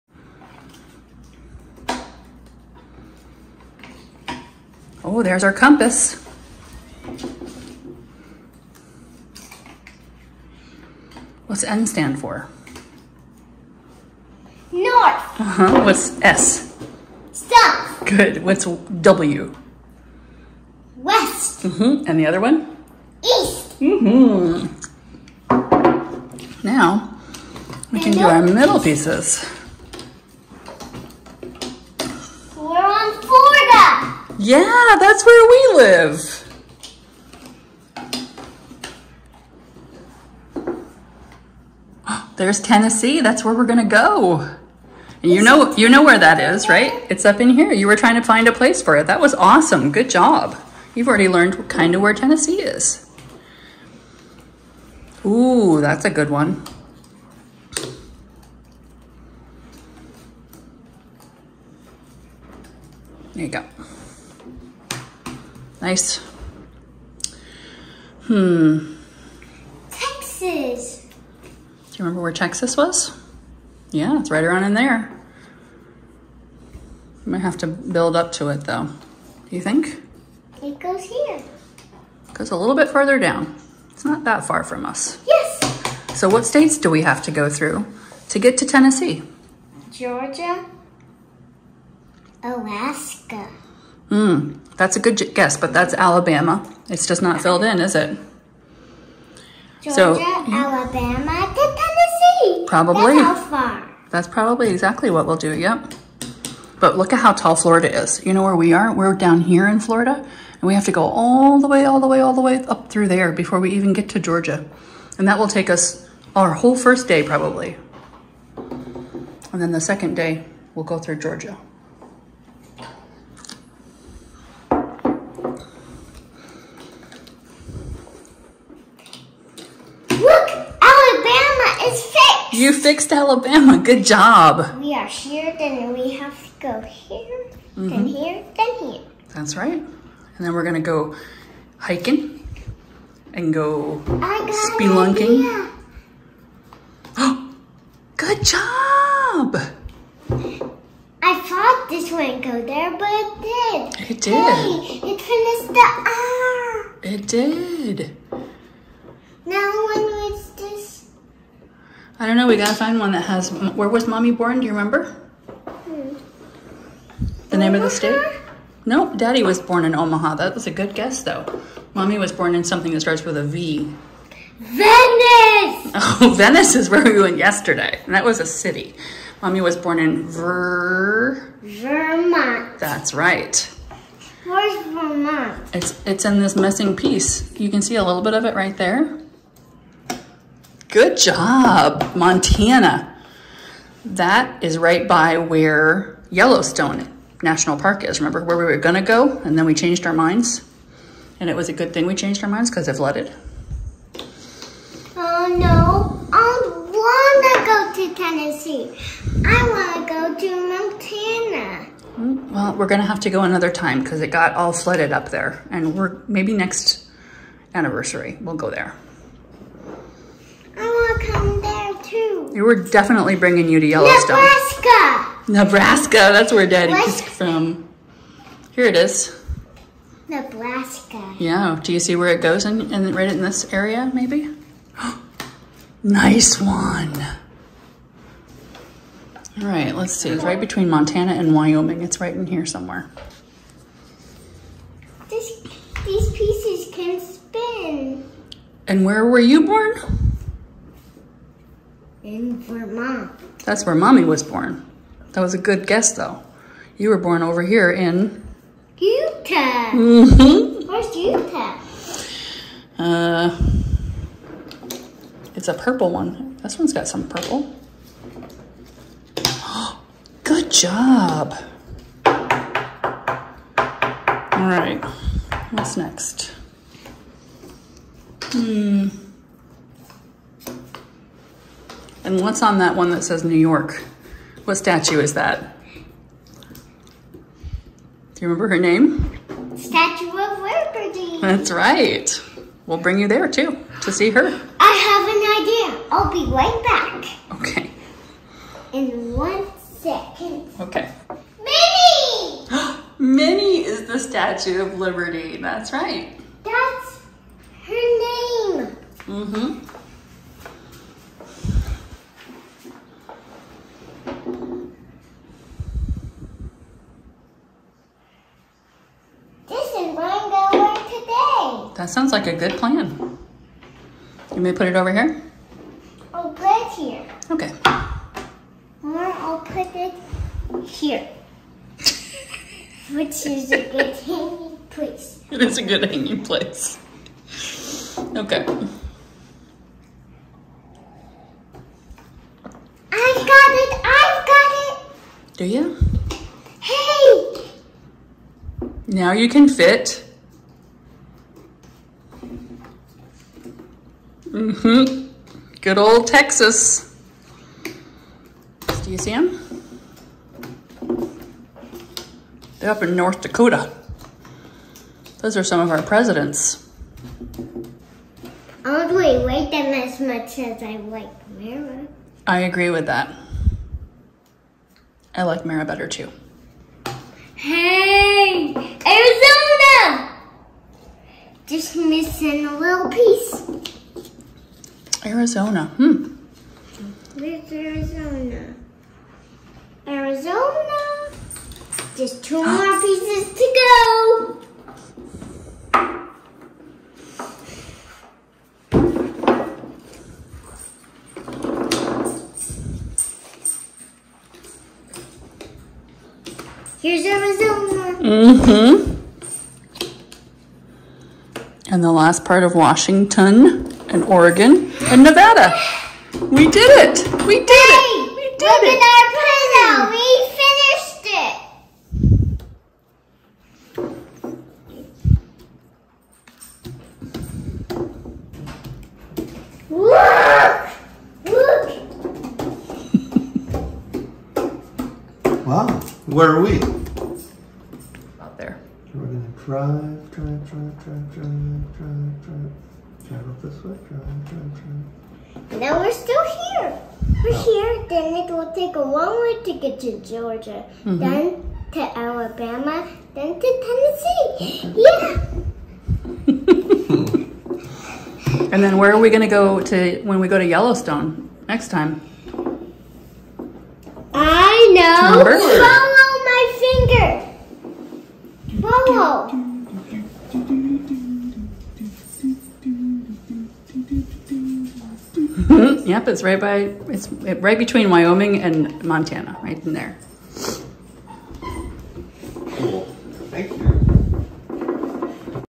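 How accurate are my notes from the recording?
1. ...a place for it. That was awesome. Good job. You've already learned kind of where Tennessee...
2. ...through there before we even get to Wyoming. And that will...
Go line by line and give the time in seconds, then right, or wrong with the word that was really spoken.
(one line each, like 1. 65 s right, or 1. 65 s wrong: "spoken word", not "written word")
1. 48 s right
2. 112 s wrong: "Georgia", not "Wyoming".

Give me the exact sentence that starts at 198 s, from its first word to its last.
Remember where we were gonna go and then we changed our minds?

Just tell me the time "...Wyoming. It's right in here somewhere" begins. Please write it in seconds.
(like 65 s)
241 s.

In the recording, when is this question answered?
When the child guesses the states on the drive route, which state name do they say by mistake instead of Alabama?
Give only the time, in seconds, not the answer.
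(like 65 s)
92 s.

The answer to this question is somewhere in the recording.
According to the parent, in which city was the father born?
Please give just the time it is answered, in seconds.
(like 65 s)
169 s.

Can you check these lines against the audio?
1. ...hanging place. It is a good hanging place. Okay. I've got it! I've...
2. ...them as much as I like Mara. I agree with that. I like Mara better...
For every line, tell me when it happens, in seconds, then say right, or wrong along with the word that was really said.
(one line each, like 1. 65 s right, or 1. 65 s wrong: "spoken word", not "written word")
1. 334 s right
2. 369 s right.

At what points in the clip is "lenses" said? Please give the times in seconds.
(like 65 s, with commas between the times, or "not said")
not said.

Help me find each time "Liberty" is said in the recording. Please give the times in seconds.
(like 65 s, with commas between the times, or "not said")
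290 s, 304 s.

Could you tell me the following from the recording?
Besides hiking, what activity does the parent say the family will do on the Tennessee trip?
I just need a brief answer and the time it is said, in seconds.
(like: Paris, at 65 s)
spelunking, at 144 s.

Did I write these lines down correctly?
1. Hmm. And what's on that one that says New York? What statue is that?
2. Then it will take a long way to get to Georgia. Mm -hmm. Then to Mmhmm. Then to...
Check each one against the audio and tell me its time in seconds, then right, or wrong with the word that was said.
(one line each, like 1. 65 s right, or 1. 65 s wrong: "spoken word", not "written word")
1. 278 s right
2. 448 s wrong: "Alabama", not "Mmhmm".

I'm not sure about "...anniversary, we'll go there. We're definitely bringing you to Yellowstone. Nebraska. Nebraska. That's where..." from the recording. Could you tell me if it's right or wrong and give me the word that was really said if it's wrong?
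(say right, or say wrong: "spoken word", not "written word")
right.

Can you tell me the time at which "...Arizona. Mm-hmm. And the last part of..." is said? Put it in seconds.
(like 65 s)
407 s.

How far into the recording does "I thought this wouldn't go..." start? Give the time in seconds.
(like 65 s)
151 s.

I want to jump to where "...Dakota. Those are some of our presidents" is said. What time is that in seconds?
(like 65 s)
363 s.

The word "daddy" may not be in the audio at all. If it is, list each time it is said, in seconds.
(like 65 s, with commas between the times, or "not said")
169 s, 226 s.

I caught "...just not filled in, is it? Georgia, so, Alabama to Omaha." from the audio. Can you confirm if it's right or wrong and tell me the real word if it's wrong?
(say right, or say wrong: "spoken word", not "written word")
wrong: "Tennessee", not "Omaha".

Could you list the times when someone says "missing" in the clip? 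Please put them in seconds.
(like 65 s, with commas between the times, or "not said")
186 s, 381 s.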